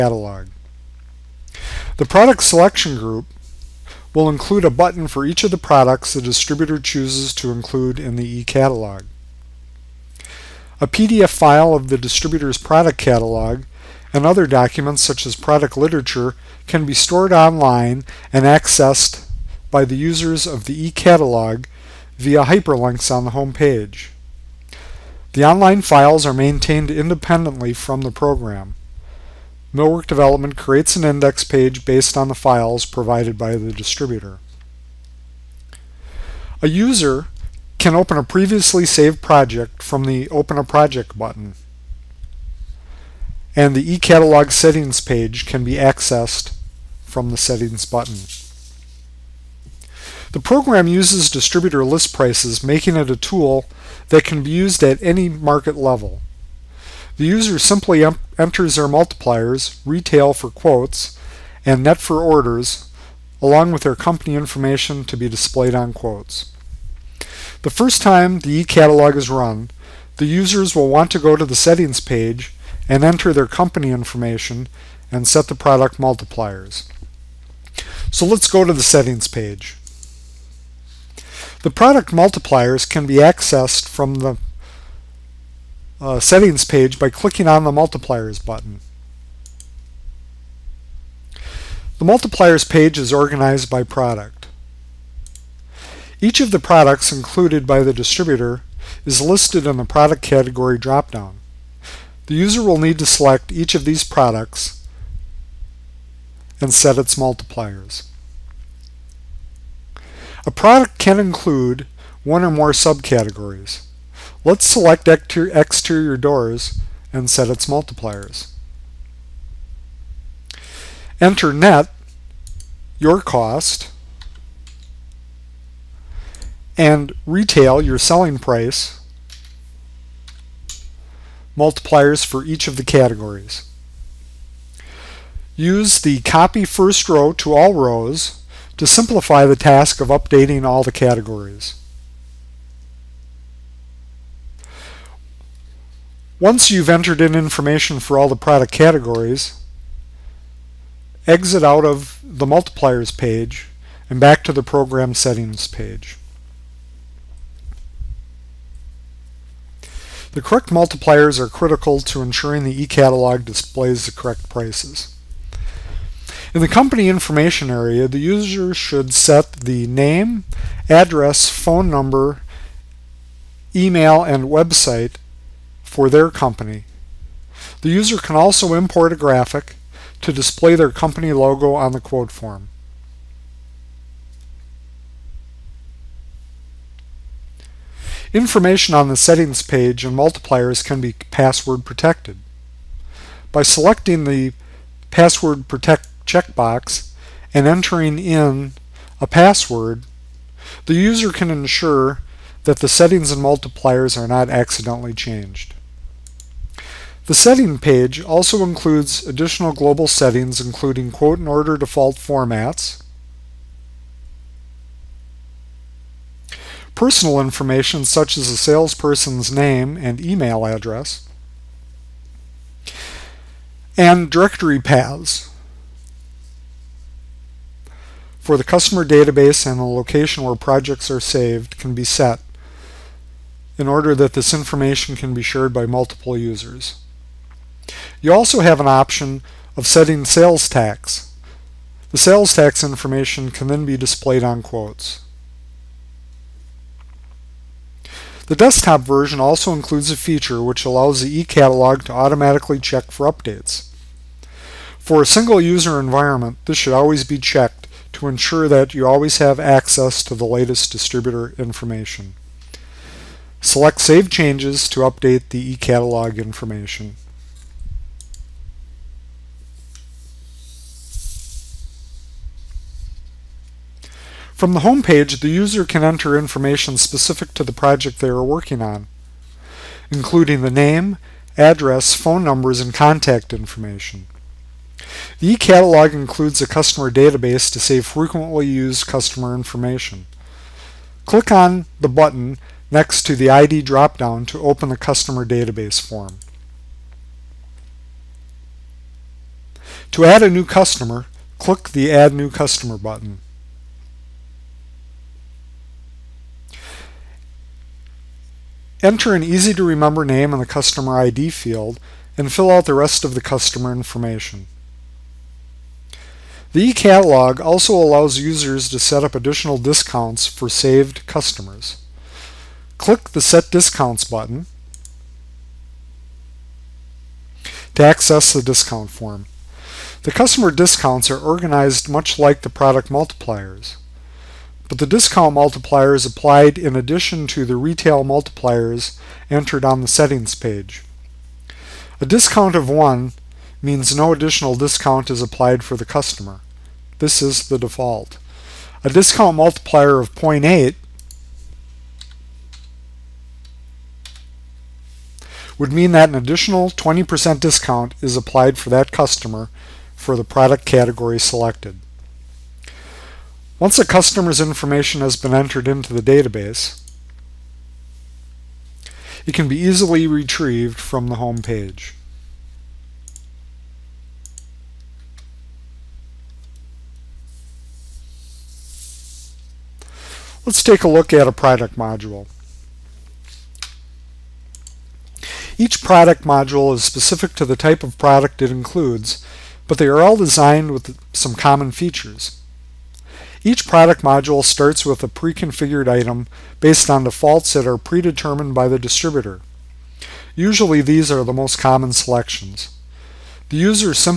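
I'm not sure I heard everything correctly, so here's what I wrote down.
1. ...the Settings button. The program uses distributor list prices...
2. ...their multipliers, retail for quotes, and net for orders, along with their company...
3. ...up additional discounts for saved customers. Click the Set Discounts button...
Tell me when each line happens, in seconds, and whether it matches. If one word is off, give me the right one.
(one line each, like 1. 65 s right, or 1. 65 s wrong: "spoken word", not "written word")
1. 47 s right
2. 58 s right
3. 319 s right.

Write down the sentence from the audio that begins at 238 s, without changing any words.
You also have an option of setting sales tax.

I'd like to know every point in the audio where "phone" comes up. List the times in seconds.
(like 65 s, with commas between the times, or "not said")
171 s, 282 s.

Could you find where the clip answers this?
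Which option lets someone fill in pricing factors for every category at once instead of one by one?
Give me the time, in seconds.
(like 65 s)
136 s.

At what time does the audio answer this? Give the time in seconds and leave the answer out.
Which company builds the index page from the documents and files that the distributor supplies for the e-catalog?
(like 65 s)
29 s.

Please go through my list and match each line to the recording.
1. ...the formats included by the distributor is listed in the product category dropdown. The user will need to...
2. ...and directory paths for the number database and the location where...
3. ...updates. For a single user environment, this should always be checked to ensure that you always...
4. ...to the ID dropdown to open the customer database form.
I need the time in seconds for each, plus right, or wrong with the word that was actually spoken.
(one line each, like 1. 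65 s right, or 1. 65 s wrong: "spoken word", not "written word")
1. 96 s wrong: "products", not "formats"
2. 223 s wrong: "customer", not "number"
3. 253 s right
4. 293 s right.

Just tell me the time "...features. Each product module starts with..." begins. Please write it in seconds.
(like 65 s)
391 s.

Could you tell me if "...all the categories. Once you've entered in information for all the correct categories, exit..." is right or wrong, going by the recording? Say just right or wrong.
wrong.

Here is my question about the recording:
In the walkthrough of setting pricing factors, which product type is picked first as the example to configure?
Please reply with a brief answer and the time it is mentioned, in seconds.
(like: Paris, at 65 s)
exterior doors, at 115 s.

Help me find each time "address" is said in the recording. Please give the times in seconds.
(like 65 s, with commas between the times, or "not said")
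170 s, 220 s, 281 s.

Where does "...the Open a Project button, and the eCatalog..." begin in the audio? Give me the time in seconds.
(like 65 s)
40 s.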